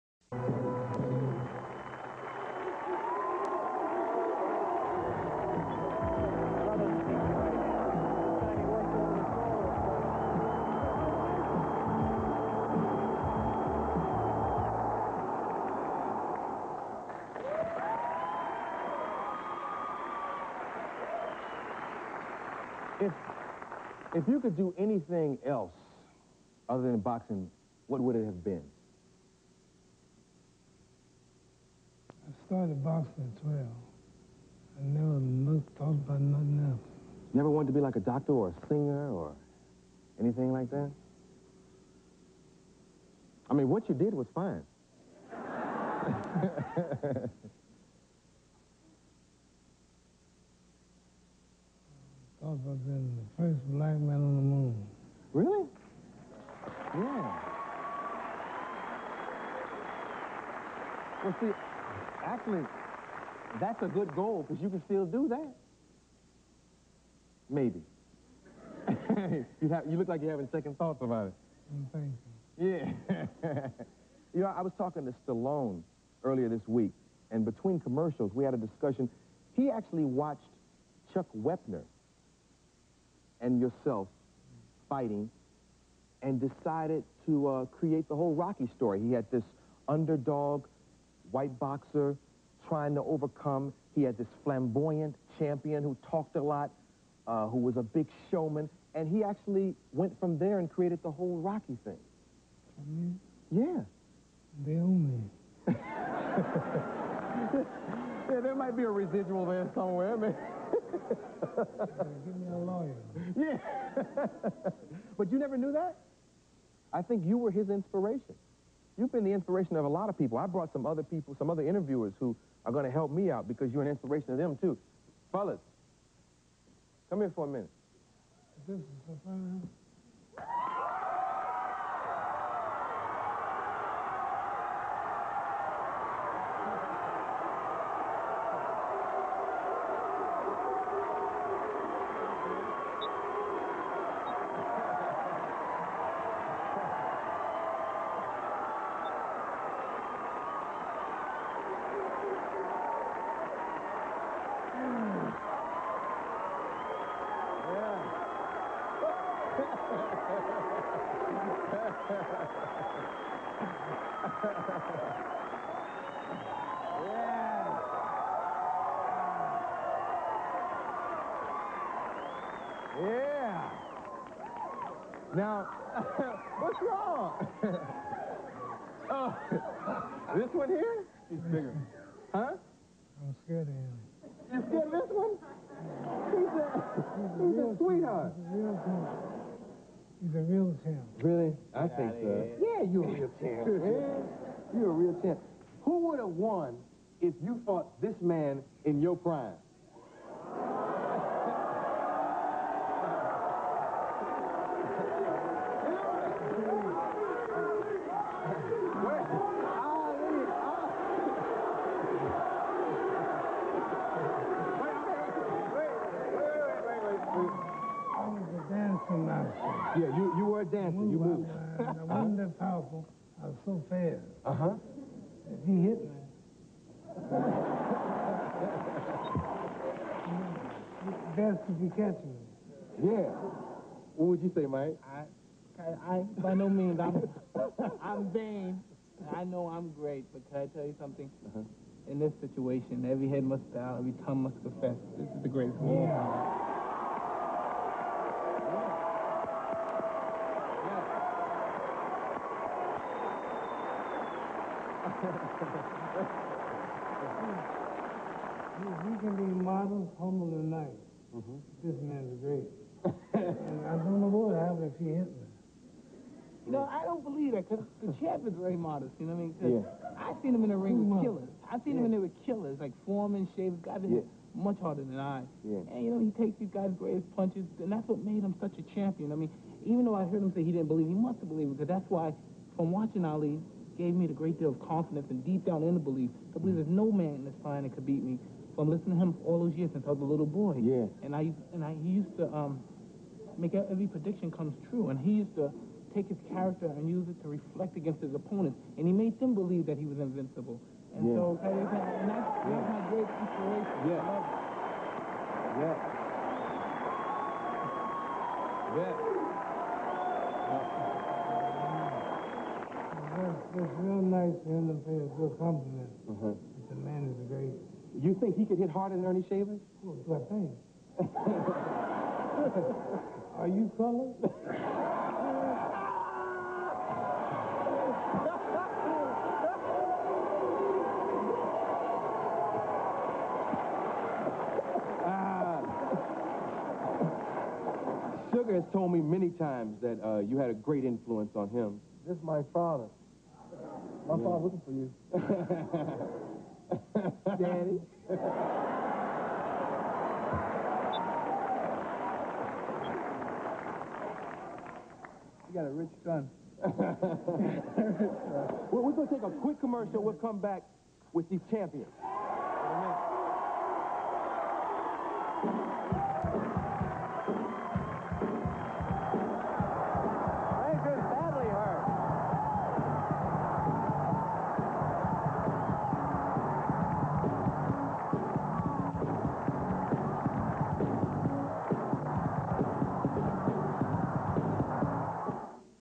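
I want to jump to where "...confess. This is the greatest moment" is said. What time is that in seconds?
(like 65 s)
244 s.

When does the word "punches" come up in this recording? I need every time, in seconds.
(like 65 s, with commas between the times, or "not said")
277 s.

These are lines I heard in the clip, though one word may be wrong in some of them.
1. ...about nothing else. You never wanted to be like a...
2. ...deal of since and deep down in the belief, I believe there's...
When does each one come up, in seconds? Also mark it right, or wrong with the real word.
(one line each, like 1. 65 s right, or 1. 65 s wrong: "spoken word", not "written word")
1. 35 s right
2. 284 s wrong: "confidence", not "since".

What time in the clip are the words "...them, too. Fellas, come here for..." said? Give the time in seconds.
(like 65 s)
124 s.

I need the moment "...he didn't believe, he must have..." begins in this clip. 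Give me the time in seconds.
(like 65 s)
280 s.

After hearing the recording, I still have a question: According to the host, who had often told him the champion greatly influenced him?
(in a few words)
Sugar.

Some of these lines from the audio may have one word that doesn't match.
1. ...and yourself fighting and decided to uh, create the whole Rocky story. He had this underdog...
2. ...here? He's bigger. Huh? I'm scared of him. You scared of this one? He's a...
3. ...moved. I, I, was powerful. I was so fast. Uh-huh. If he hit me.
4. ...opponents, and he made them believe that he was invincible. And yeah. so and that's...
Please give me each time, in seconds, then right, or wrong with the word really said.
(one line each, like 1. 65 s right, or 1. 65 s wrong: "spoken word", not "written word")
1. 83 s right
2. 180 s right
3. 221 s right
4. 298 s right.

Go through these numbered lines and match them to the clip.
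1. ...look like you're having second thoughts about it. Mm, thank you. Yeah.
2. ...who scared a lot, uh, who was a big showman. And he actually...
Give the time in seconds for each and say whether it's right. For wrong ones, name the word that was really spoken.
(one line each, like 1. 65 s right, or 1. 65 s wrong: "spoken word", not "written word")
1. 69 s right
2. 95 s wrong: "talked", not "scared".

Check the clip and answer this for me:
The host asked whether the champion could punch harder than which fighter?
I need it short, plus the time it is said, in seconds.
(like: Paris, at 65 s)
Earnie Shavers, at 319 s.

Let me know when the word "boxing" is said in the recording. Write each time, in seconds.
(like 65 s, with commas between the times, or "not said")
26 s, 32 s.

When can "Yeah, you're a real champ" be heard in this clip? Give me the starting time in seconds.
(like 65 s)
192 s.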